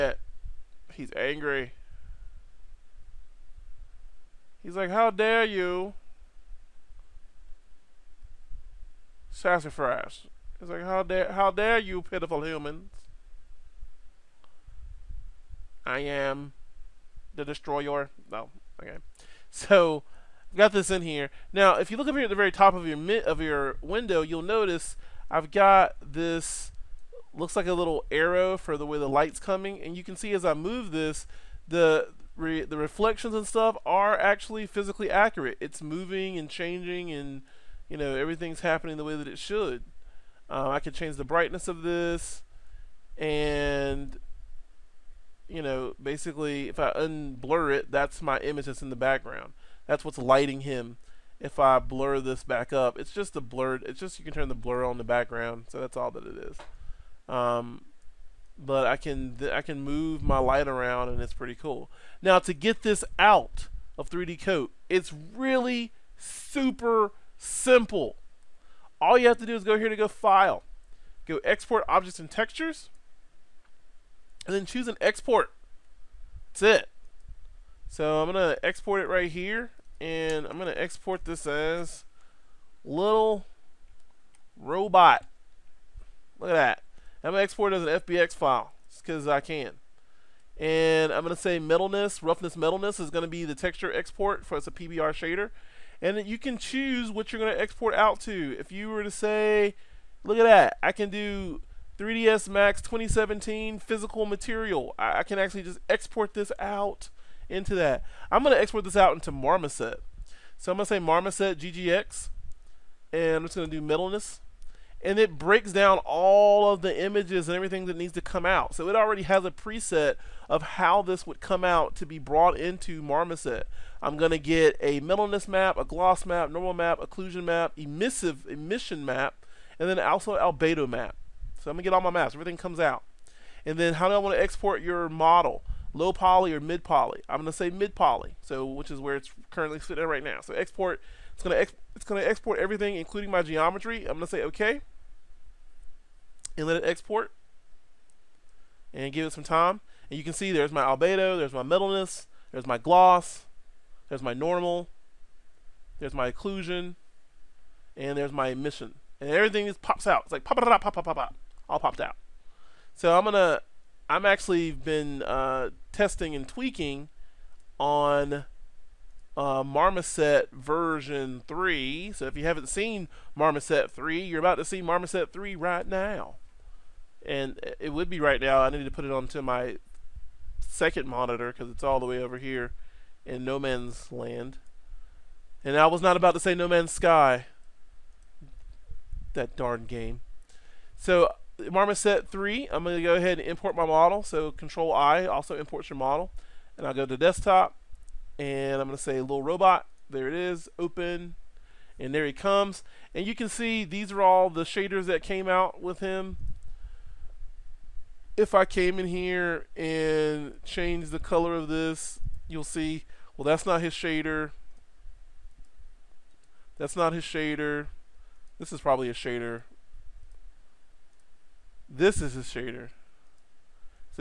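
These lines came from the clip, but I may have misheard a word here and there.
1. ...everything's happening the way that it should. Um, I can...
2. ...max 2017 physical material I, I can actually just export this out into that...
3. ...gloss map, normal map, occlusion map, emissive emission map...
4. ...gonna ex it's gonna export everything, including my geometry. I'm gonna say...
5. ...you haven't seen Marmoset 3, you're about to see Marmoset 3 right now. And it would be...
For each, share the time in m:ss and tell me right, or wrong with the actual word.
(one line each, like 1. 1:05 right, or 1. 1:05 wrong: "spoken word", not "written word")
1. 0:38 right
2. 1:42 right
3. 2:05 right
4. 2:21 right
5. 2:52 right.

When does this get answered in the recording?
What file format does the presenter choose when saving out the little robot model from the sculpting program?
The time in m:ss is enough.
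1:28.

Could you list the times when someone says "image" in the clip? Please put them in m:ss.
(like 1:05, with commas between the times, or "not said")
0:48, 1:57.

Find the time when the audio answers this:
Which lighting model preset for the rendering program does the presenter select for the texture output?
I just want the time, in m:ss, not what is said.
1:50.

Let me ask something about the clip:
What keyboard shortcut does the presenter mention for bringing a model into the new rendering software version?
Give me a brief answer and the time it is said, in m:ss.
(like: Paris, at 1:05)
Control I, at 3:14.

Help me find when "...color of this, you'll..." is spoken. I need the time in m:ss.
3:31.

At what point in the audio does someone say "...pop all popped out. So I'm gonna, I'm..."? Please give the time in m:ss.
2:41.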